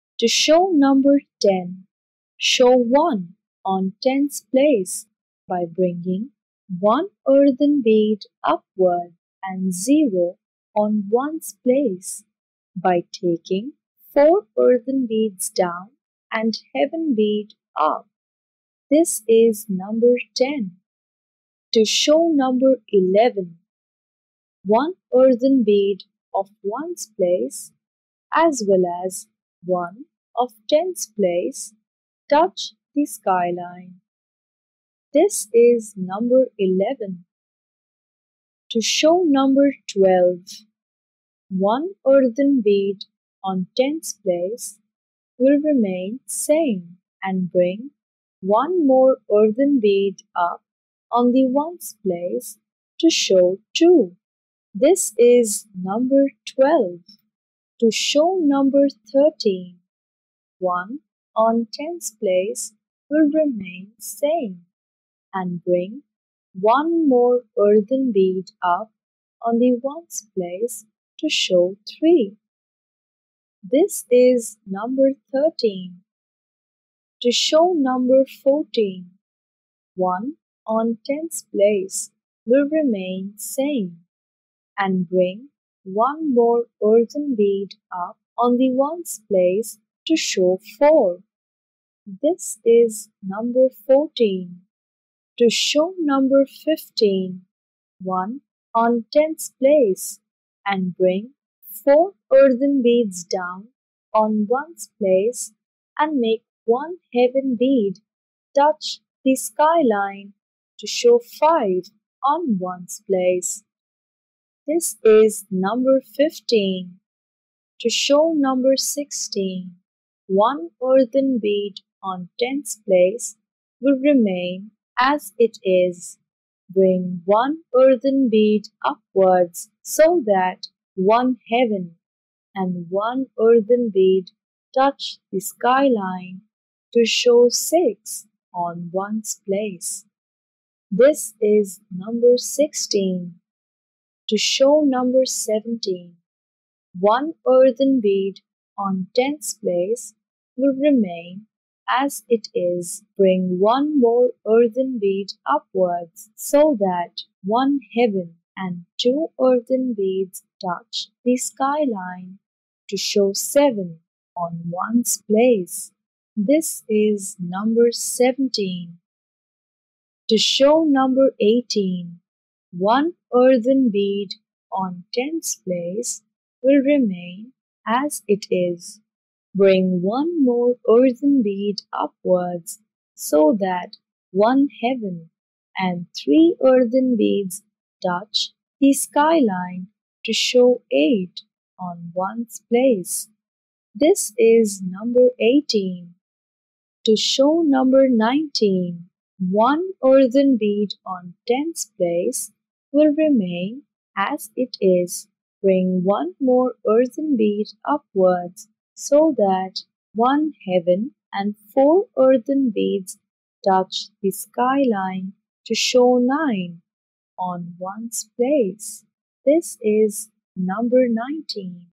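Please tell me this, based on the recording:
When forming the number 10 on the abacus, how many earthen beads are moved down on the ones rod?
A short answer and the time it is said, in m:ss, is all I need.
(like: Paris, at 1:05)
4, at 0:14.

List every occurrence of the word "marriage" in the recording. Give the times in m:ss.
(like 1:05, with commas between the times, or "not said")
not said.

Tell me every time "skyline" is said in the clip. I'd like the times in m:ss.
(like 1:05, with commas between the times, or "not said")
0:33, 1:49, 2:15, 2:41, 3:08, 3:34.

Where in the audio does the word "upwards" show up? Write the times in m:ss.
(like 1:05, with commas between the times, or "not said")
0:08, 2:08, 2:35, 3:01, 3:27.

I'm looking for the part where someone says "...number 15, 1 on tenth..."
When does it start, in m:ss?
1:35.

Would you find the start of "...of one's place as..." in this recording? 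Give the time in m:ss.
0:26.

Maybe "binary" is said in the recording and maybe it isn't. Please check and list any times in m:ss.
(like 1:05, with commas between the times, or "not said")
not said.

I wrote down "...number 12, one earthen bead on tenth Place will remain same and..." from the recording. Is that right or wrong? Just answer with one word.
right.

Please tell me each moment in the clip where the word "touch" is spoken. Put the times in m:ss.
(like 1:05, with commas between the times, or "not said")
0:32, 1:48, 2:14, 2:40, 3:08, 3:33.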